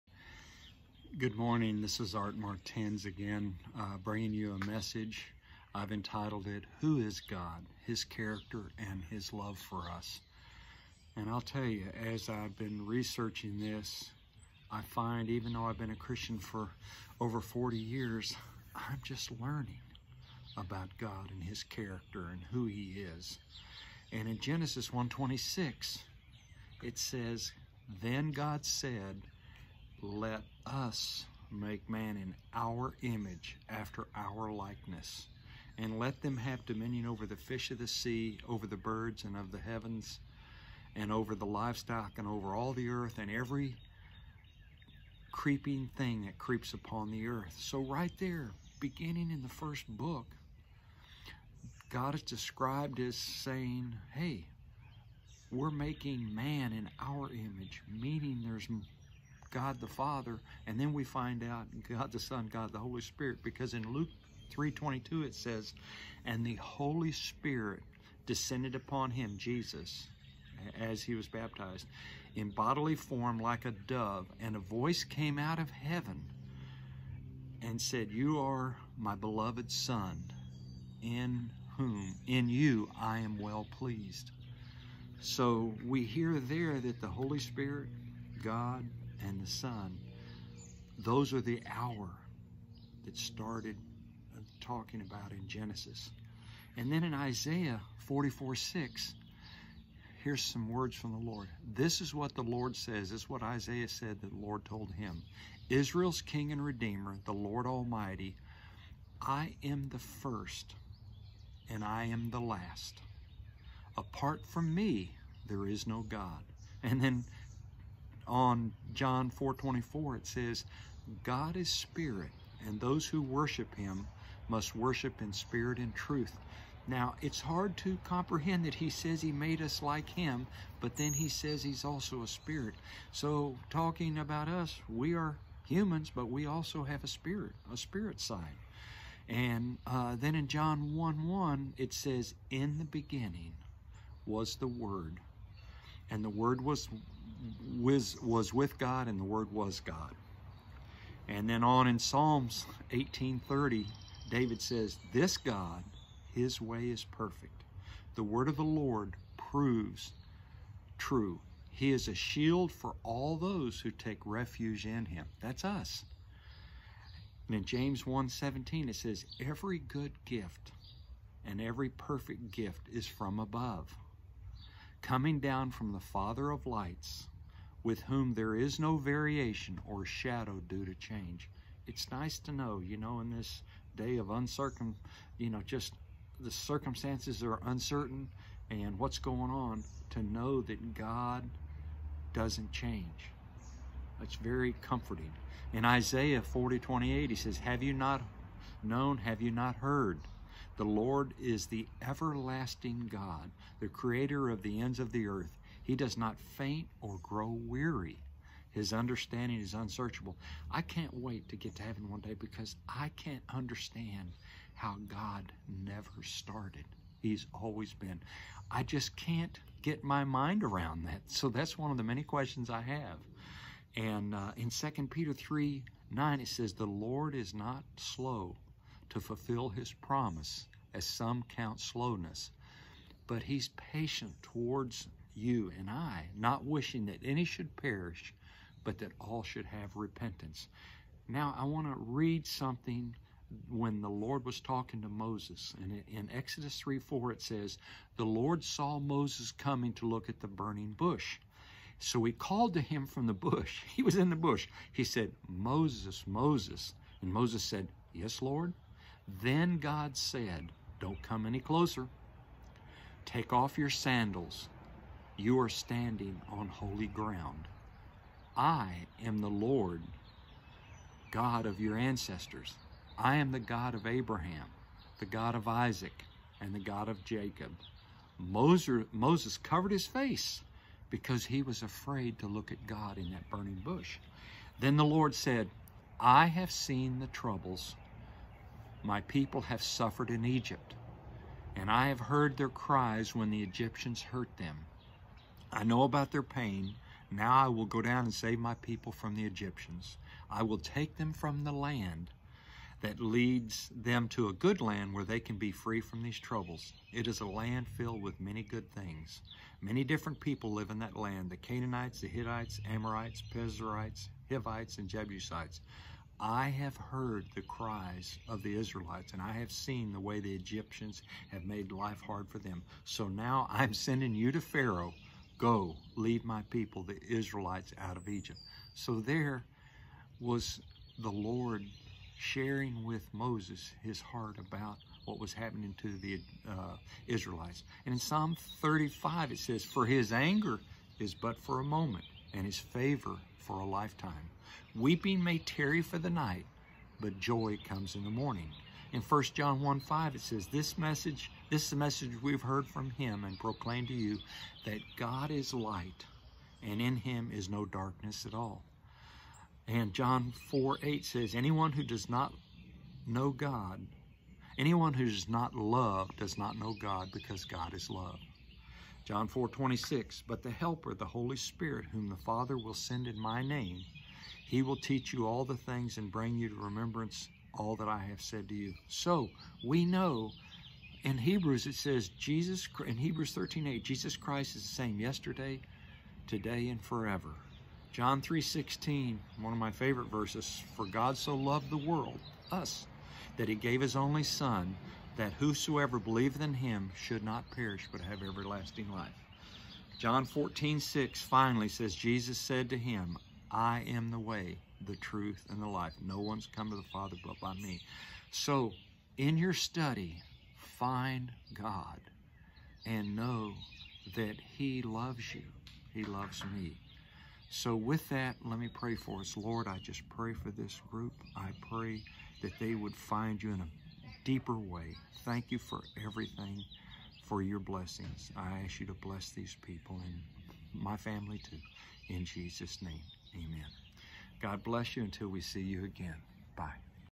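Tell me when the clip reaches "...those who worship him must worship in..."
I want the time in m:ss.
2:02.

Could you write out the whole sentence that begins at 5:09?
Many different people live in that land the Canaanites, the Hittites, Amorites, Pezerites, Hivites, and Jebusites.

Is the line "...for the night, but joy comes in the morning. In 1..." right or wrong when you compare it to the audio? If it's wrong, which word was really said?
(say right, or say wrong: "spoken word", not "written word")
right.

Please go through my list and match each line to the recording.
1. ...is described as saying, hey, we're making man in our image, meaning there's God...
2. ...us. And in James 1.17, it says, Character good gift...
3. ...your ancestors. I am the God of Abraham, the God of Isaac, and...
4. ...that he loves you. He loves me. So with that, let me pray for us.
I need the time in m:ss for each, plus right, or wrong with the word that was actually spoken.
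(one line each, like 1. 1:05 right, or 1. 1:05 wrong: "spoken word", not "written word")
1. 0:52 right
2. 2:45 wrong: "Every", not "Character"
3. 4:31 right
4. 6:54 right.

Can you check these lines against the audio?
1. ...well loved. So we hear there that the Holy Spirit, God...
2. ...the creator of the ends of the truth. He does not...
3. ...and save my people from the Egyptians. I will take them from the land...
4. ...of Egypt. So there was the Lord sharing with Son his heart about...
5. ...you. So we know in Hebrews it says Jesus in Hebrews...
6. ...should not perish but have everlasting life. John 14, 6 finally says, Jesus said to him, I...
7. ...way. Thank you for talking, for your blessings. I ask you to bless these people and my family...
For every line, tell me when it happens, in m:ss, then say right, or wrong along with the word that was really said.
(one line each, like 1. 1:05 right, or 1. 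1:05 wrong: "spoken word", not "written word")
1. 1:23 wrong: "pleased", not "loved"
2. 3:23 wrong: "earth", not "truth"
3. 4:58 right
4. 5:28 wrong: "Moses", not "Son"
5. 6:18 right
6. 6:37 right
7. 7:04 wrong: "everything", not "talking".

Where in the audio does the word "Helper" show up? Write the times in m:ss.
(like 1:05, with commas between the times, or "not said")
6:10.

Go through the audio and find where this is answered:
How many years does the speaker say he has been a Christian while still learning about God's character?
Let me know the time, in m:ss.
0:17.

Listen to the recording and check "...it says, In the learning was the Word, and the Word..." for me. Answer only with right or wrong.
wrong.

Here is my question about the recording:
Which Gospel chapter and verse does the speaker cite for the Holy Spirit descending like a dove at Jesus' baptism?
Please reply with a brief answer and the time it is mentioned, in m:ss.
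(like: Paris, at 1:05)
Luke 3:22, at 1:03.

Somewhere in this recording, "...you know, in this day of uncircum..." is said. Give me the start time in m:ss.
3:02.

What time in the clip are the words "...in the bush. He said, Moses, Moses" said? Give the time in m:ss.
4:14.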